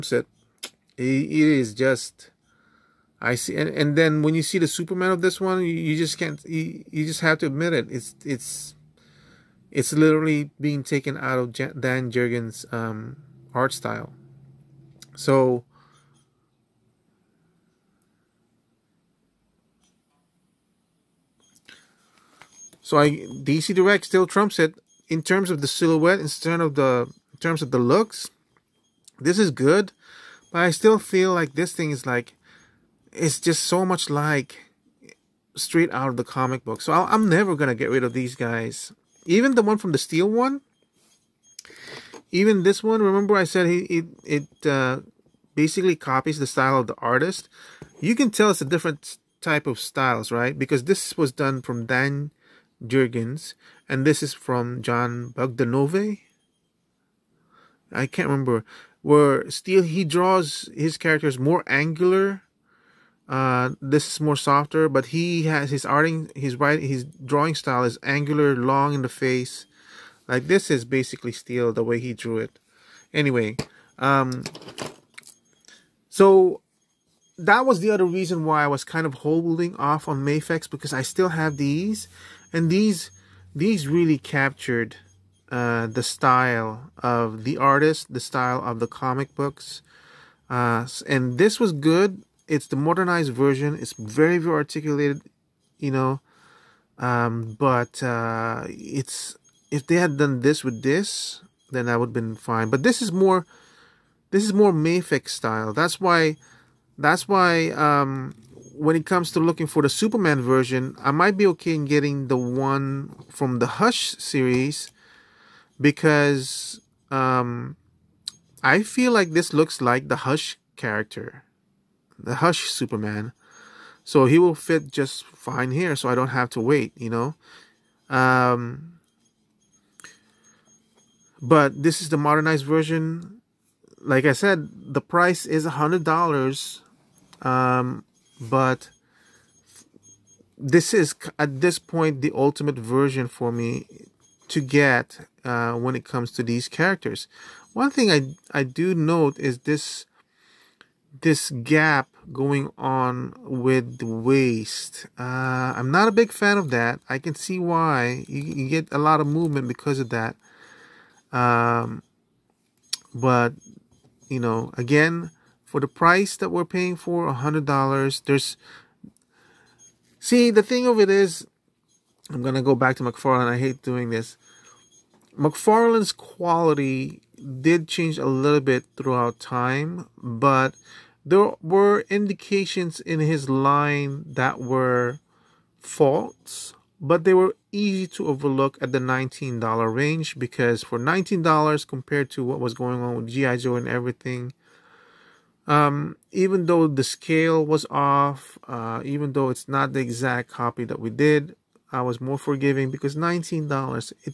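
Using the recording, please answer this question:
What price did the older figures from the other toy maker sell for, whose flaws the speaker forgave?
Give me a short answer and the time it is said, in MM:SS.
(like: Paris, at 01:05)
$19, at 03:08.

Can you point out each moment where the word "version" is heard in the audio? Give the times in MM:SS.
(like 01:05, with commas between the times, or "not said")
01:33, 01:50, 02:12, 02:22.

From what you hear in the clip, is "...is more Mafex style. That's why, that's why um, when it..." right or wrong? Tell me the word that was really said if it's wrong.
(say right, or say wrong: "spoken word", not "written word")
right.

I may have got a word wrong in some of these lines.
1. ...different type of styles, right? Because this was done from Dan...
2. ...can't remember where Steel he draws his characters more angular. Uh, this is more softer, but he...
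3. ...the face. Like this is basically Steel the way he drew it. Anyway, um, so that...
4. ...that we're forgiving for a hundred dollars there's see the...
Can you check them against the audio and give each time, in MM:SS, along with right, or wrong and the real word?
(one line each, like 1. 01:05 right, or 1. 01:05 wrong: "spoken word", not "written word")
1. 00:48 right
2. 00:58 right
3. 01:09 right
4. 02:46 wrong: "paying", not "forgiving".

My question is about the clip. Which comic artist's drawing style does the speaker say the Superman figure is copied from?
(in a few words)
Dan Jurgens.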